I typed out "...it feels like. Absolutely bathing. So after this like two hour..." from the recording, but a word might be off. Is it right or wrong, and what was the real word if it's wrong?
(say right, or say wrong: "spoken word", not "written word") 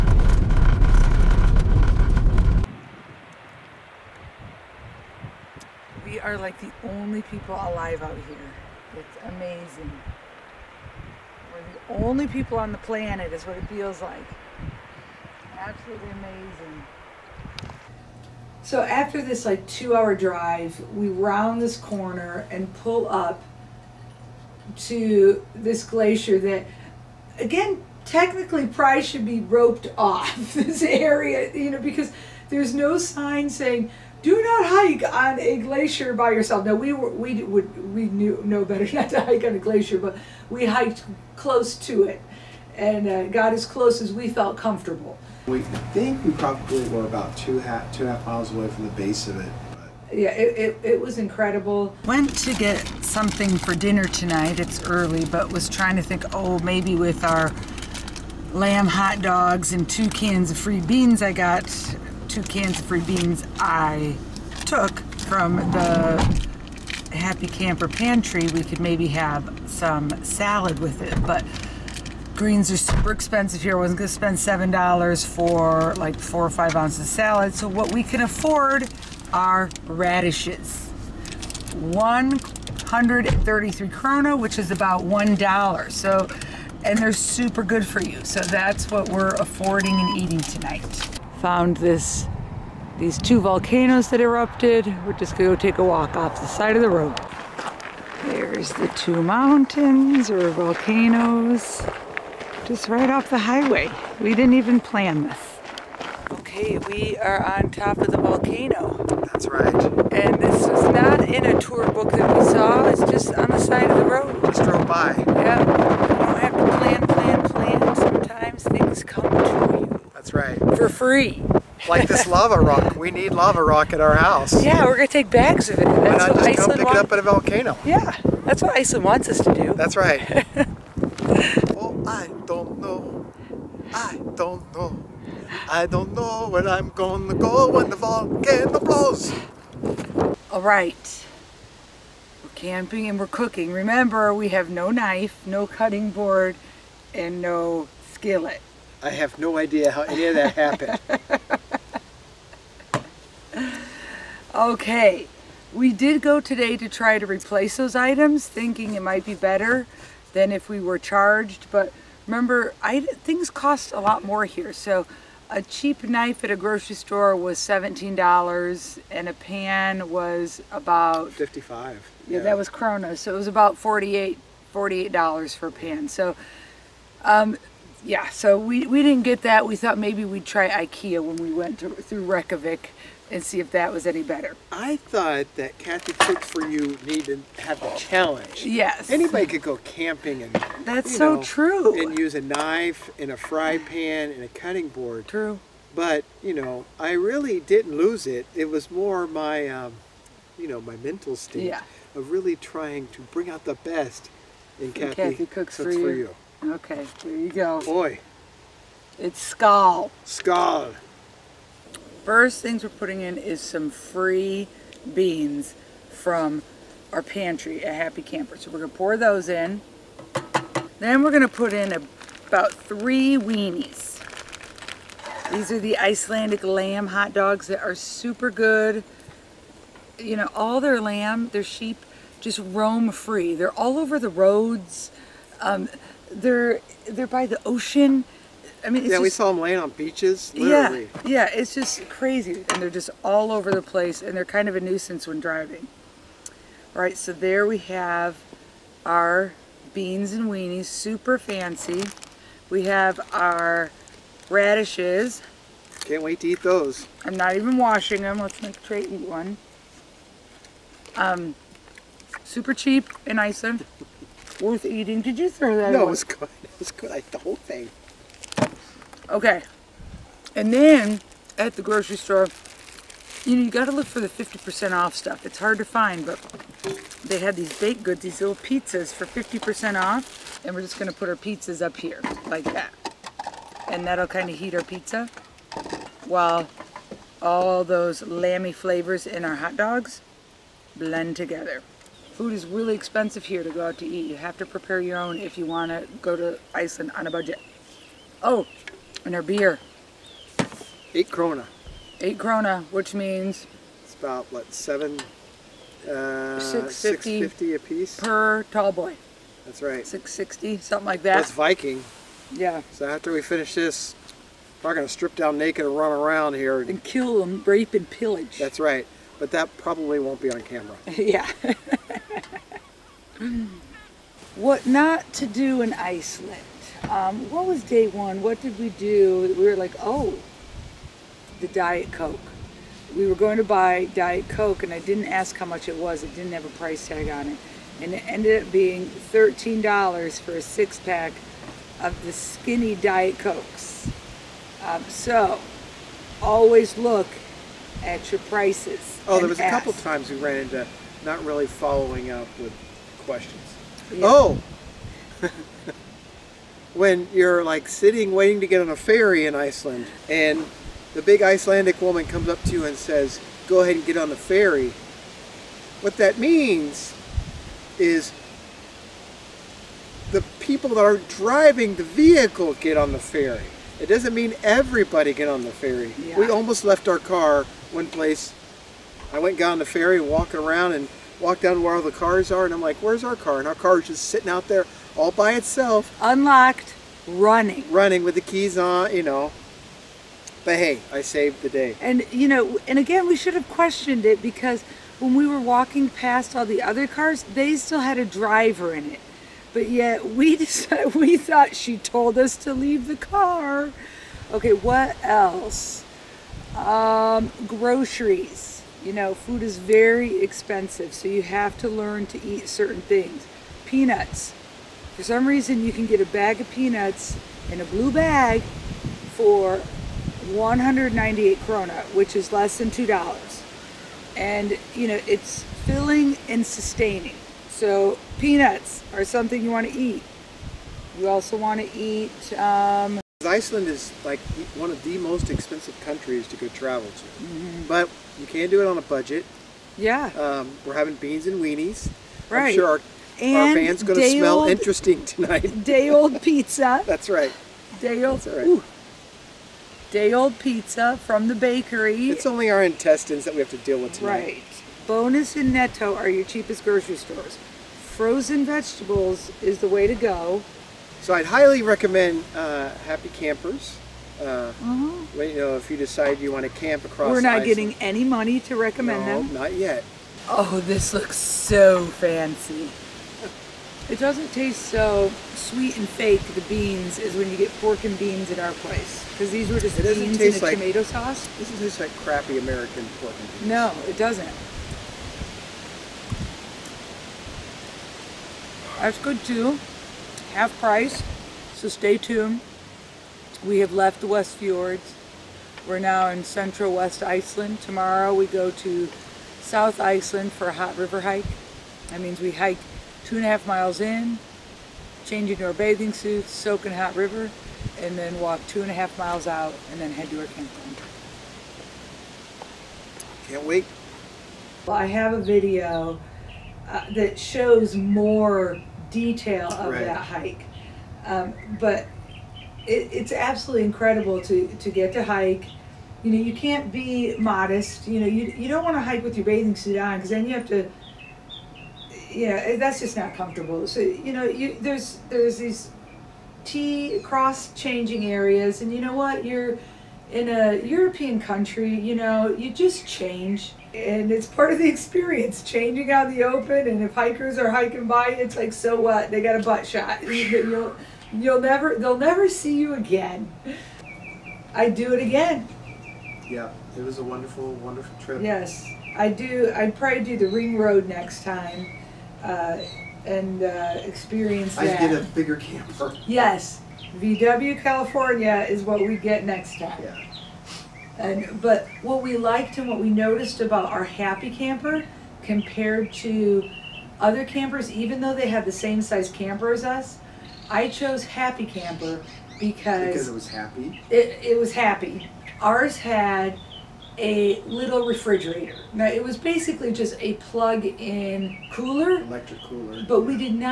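wrong: "amazing", not "bathing".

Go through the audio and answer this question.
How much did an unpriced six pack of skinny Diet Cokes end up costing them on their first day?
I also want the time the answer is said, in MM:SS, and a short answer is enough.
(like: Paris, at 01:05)
$13, at 05:39.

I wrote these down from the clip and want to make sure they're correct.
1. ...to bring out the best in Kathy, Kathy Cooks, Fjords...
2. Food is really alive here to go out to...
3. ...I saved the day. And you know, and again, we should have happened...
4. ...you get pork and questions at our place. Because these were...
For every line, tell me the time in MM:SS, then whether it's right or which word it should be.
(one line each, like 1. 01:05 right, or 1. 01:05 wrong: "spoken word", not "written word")
1. 03:23 wrong: "Cooks", not "Fjords"
2. 04:52 wrong: "expensive", not "alive"
3. 06:31 wrong: "questioned", not "happened"
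4. 07:57 wrong: "beans", not "questions".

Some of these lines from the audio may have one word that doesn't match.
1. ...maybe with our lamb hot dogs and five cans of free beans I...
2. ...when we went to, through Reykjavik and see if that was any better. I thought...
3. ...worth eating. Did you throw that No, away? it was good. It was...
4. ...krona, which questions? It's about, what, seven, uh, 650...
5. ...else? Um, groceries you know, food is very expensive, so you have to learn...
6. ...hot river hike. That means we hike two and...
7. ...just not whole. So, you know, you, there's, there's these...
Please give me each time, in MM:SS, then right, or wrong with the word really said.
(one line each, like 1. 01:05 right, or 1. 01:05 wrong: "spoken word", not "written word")
1. 00:56 wrong: "two", not "five"
2. 03:01 right
3. 04:24 right
4. 05:02 wrong: "means", not "questions"
5. 06:45 right
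6. 08:20 right
7. 08:52 wrong: "comfortable", not "whole".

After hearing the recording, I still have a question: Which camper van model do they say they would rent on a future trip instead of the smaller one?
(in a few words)
VW California.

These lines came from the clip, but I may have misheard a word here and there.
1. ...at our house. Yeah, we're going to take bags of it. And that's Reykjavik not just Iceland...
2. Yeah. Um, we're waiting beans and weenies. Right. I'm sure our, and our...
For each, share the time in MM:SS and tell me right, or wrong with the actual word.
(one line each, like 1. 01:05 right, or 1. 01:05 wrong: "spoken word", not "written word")
1. 02:03 wrong: "Why", not "Reykjavik"
2. 07:19 wrong: "having", not "waiting".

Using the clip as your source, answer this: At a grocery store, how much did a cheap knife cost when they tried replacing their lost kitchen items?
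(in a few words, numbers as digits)
$17.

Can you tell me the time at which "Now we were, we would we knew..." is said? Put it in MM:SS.
00:36.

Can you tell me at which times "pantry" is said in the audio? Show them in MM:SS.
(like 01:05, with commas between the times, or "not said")
01:07, 03:37.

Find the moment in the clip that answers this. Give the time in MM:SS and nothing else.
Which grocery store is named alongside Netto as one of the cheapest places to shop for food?
07:35.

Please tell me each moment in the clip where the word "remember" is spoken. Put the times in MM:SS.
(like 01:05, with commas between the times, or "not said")
02:23, 02:42.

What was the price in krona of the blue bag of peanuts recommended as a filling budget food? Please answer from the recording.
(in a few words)
198 krona.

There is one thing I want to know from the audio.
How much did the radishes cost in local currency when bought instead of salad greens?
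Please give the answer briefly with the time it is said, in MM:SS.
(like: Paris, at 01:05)
133 krona, at 01:21.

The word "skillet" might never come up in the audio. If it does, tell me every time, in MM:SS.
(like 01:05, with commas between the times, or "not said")
02:28.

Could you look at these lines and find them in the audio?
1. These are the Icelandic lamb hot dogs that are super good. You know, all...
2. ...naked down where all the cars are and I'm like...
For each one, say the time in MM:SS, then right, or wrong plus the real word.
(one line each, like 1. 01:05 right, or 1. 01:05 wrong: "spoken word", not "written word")
1. 03:45 right
2. 06:21 wrong: "walked", not "naked".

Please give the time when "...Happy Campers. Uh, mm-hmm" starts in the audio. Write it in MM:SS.
07:43.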